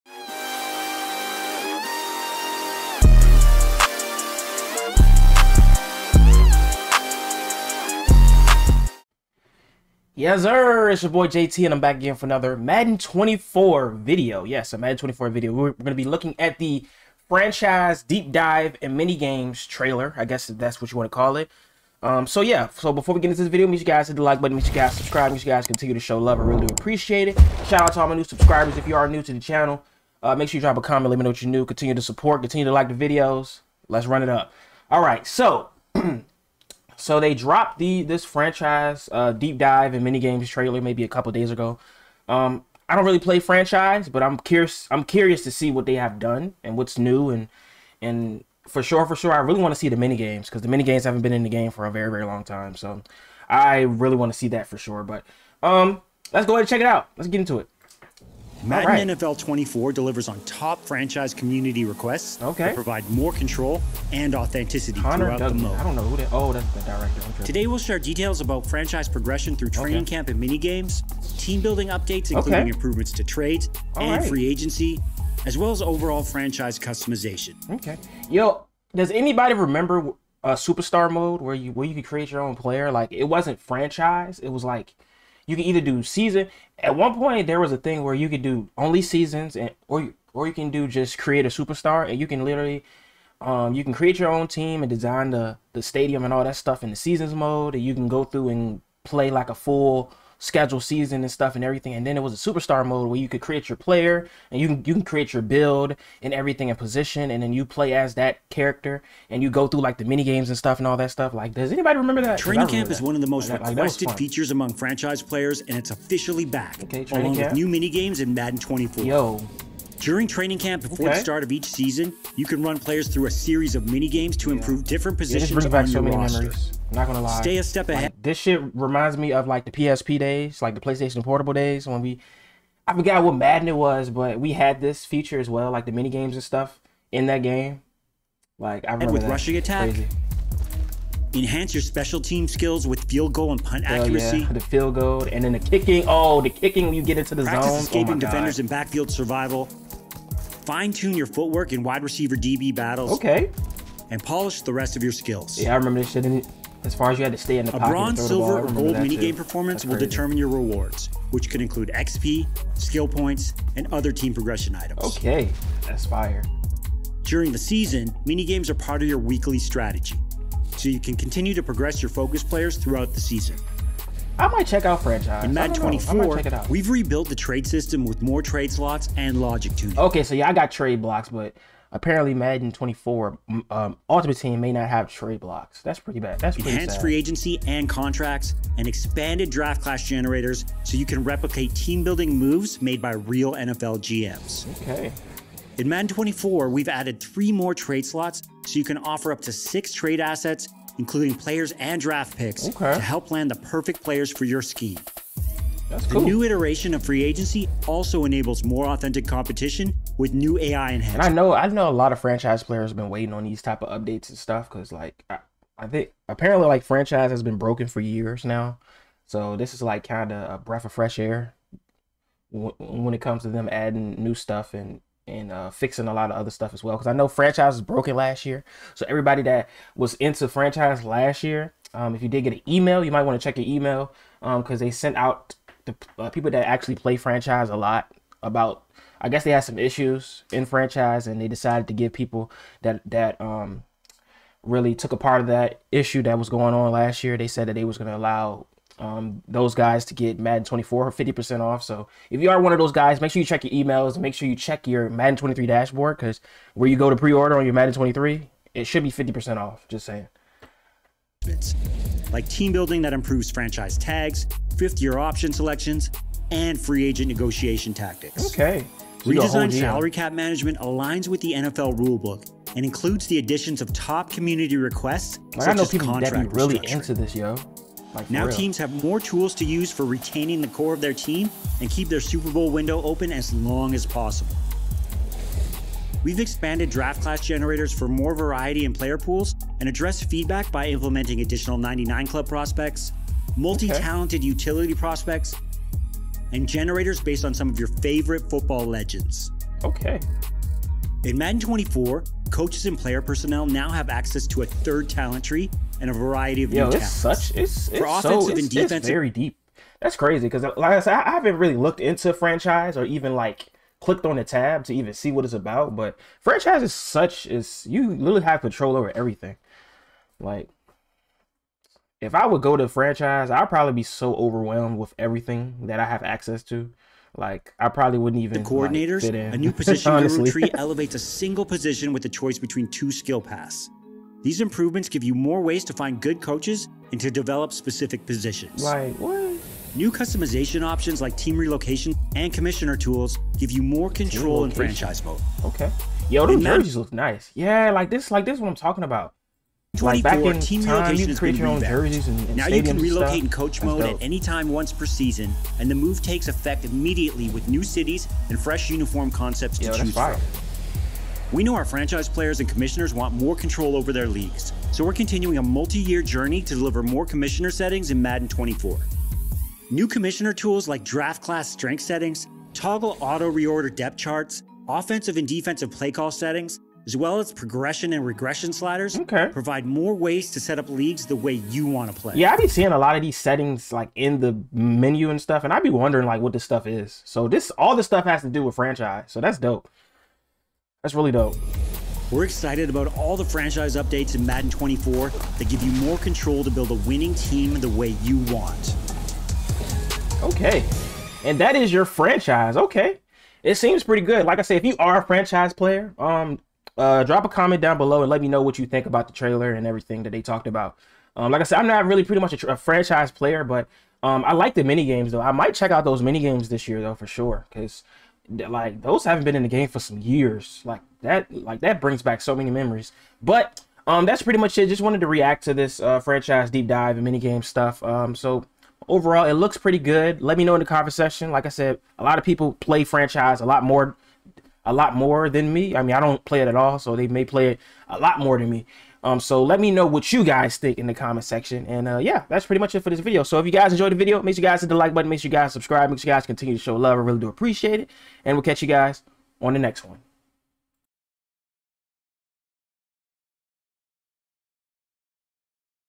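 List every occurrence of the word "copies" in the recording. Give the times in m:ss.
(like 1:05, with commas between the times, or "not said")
not said.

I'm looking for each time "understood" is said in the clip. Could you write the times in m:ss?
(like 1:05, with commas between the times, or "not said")
not said.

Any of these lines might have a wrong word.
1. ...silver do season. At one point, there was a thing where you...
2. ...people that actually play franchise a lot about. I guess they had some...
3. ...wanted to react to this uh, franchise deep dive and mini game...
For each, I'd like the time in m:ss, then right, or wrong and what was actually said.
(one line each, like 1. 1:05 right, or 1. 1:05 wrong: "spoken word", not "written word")
1. 1:25 wrong: "either", not "silver"
2. 3:56 right
3. 7:05 right.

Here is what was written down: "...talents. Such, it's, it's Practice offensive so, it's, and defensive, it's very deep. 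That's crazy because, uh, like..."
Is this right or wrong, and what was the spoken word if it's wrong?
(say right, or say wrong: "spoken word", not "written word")
wrong: "For", not "Practice".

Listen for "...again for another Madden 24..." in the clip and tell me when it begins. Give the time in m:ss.
0:11.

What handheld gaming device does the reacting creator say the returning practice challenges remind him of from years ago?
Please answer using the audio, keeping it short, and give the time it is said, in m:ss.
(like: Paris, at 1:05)
PlayStation Portable, at 2:10.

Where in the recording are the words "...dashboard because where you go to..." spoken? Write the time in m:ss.
4:15.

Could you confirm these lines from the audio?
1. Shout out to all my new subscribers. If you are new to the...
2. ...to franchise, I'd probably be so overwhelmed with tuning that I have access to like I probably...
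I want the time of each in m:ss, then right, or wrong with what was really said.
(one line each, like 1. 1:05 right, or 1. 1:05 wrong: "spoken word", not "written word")
1. 0:27 right
2. 5:22 wrong: "everything", not "tuning".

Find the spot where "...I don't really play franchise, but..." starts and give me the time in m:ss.
0:42.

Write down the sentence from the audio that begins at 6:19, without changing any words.
provide more ways to set up leagues the way you want to play.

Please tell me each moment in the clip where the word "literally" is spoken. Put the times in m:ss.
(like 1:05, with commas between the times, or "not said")
1:32, 5:18.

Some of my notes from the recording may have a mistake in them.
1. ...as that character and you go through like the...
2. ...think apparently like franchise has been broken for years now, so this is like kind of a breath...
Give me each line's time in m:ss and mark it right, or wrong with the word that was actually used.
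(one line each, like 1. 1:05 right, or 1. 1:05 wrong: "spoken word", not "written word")
1. 1:47 right
2. 3:35 right.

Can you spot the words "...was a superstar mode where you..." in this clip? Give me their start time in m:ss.
1:42.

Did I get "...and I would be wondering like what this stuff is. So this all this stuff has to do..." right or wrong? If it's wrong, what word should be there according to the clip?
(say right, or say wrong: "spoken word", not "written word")
right.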